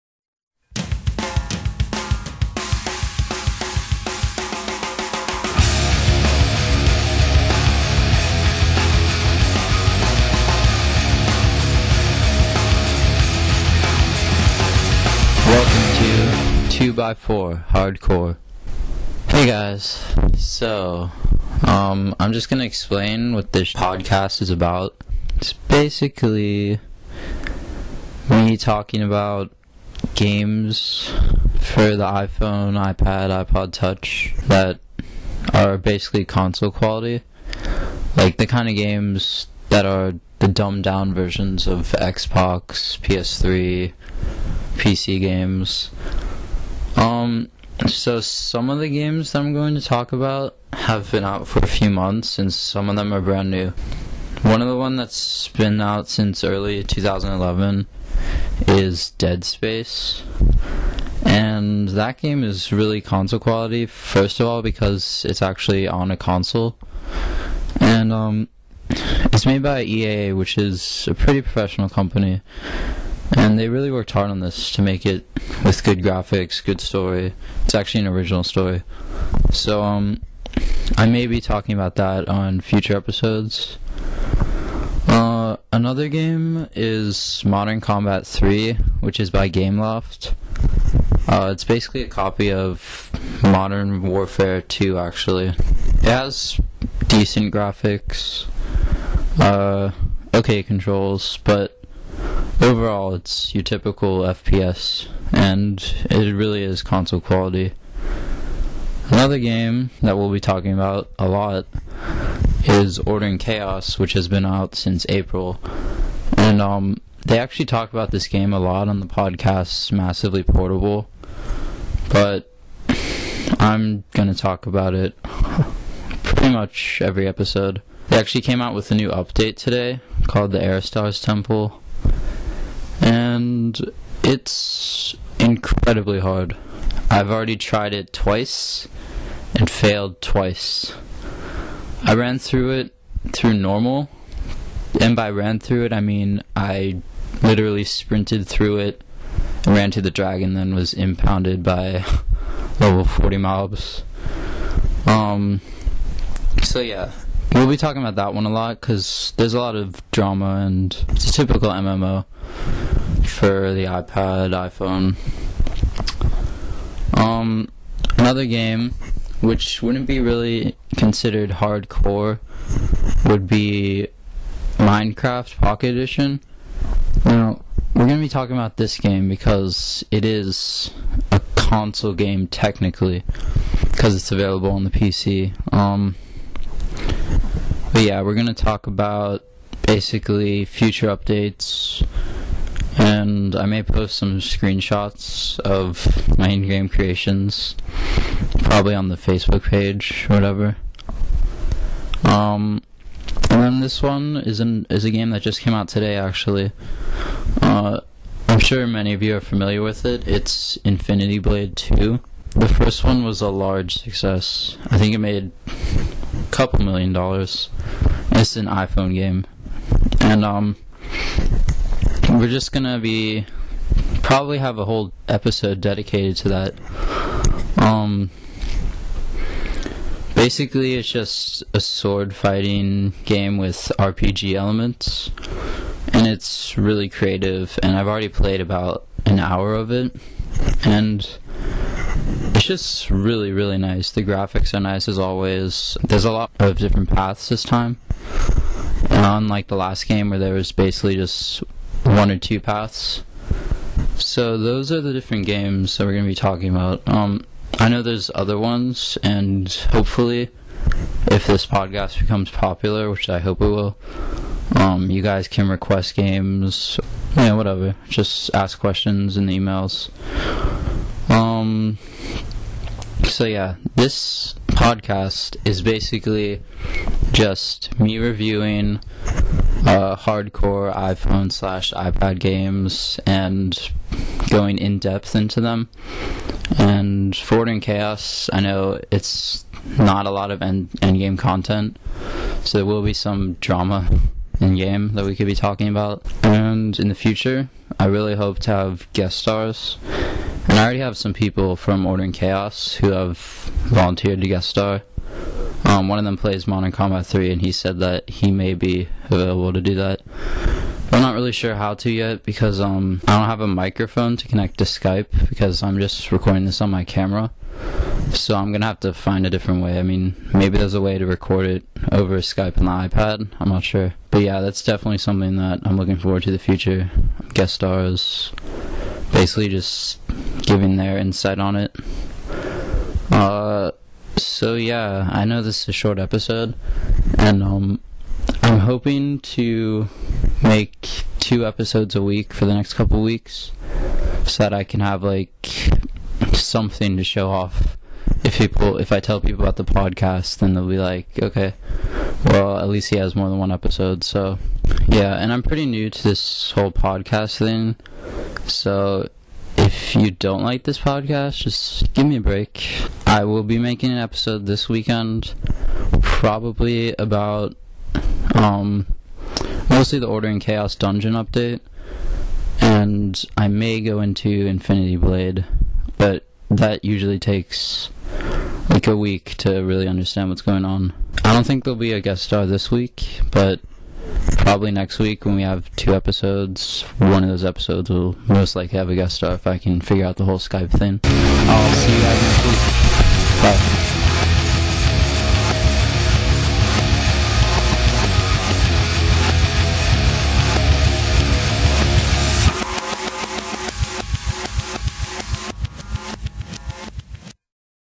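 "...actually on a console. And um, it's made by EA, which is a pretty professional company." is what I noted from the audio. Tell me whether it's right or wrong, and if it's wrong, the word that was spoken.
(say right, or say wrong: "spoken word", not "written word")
right.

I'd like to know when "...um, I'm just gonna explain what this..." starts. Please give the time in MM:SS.
00:21.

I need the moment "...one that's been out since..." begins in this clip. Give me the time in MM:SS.
00:54.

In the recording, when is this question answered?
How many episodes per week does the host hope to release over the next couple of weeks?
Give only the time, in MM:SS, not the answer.
05:41.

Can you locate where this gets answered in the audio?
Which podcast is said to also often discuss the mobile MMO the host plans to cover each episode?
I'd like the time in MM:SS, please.
01:59.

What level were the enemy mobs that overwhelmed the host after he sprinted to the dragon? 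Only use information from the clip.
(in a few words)
40.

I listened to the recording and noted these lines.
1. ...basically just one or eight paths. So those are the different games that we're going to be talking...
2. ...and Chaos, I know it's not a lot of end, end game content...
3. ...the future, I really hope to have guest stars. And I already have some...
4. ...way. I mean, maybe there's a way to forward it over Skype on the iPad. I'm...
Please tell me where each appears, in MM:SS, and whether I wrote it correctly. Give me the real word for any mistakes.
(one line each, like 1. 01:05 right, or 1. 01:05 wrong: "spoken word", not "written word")
1. 04:10 wrong: "two", not "eight"
2. 04:47 right
3. 04:57 right
4. 05:19 wrong: "record", not "forward".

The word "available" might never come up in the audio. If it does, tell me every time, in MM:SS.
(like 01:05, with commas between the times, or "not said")
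03:04, 05:09.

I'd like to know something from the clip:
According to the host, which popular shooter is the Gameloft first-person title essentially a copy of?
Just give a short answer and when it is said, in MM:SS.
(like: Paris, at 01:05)
Modern Warfare 2, at 01:33.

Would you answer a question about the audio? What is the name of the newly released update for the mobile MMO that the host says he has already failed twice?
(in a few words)
Aerostars Temple.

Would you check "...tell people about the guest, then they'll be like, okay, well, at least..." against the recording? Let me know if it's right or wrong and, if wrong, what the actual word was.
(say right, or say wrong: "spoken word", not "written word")
wrong: "podcast", not "guest".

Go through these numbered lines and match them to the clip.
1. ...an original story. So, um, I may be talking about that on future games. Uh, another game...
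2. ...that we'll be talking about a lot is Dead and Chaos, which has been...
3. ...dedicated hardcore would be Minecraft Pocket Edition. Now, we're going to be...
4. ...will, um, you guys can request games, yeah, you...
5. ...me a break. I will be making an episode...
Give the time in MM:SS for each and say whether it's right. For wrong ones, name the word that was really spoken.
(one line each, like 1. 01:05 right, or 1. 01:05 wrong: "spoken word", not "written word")
1. 01:18 wrong: "episodes", not "games"
2. 01:50 wrong: "Order", not "Dead"
3. 02:50 wrong: "considered", not "dedicated"
4. 04:23 right
5. 06:02 right.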